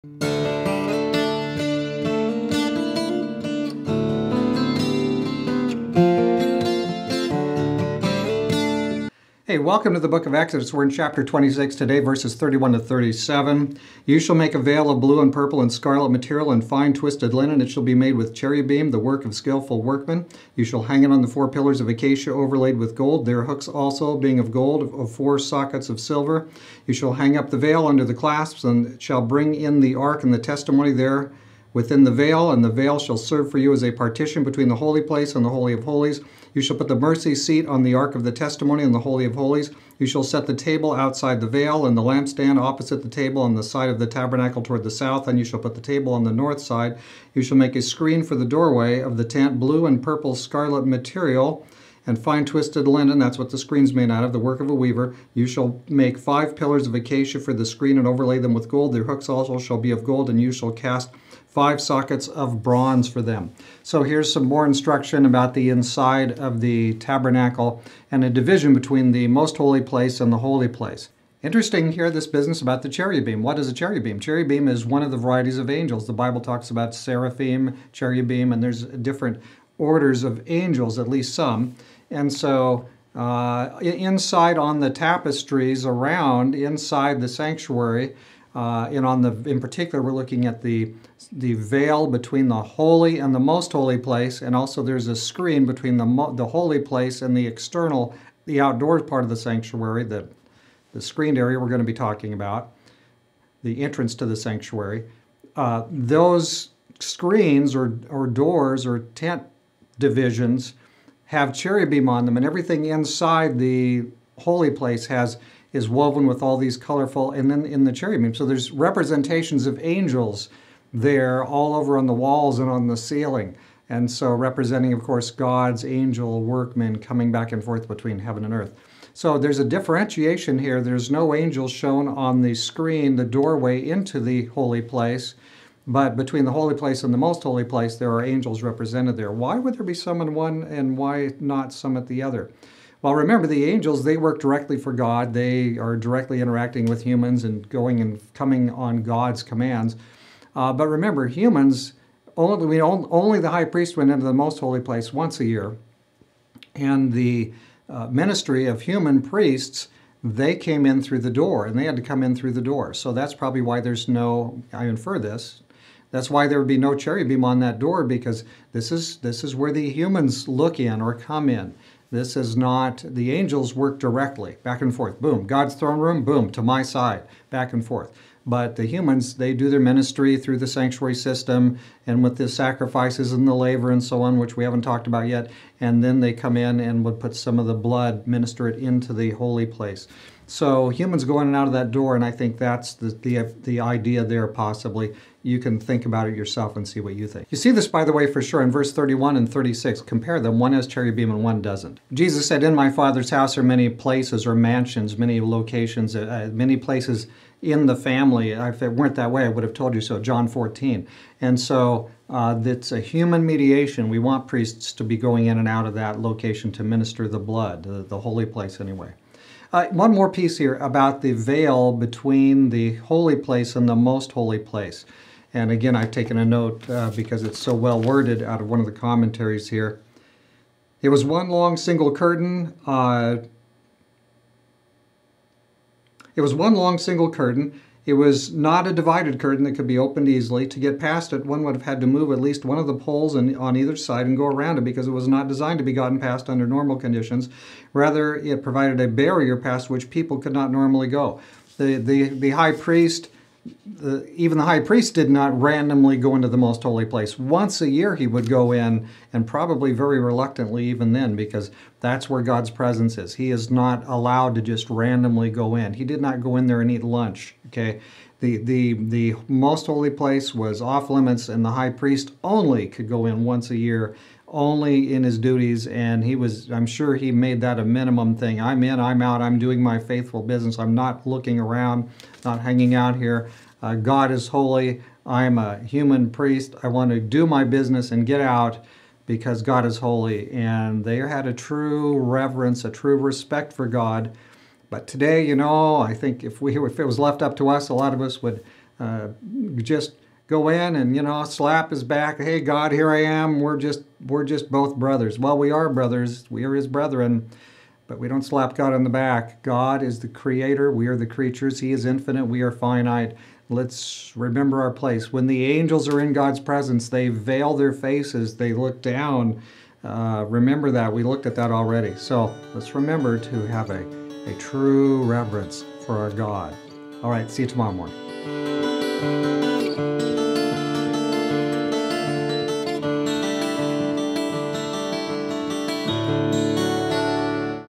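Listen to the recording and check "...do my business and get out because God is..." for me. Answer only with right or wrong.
right.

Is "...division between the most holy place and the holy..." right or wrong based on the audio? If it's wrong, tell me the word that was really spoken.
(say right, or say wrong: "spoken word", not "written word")
right.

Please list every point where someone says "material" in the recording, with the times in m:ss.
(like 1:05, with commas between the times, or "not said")
0:16, 0:50.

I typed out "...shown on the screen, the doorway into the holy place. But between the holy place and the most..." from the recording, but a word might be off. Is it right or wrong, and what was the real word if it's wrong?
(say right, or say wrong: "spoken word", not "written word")
right.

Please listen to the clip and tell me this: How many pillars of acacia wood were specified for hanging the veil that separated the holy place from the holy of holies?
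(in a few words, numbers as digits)
4.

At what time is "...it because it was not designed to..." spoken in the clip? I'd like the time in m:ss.
4:04.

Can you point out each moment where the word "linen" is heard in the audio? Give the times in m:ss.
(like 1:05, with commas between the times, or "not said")
0:17, 0:52.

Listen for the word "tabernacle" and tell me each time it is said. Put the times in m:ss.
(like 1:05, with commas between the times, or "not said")
0:44, 1:06.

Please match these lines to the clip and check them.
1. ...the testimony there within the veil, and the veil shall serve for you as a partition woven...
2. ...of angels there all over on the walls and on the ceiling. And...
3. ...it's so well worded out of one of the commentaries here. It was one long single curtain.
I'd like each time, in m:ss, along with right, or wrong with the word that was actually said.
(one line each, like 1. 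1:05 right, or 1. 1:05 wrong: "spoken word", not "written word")
1. 0:30 wrong: "between", not "woven"
2. 1:59 right
3. 3:47 right.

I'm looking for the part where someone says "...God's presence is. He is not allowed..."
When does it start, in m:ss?
4:22.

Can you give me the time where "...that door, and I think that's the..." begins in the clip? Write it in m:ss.
3:11.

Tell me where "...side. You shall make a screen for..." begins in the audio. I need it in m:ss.
0:46.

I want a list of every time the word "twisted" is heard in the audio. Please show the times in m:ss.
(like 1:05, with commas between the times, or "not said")
0:16, 0:52.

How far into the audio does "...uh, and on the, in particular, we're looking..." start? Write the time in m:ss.
1:28.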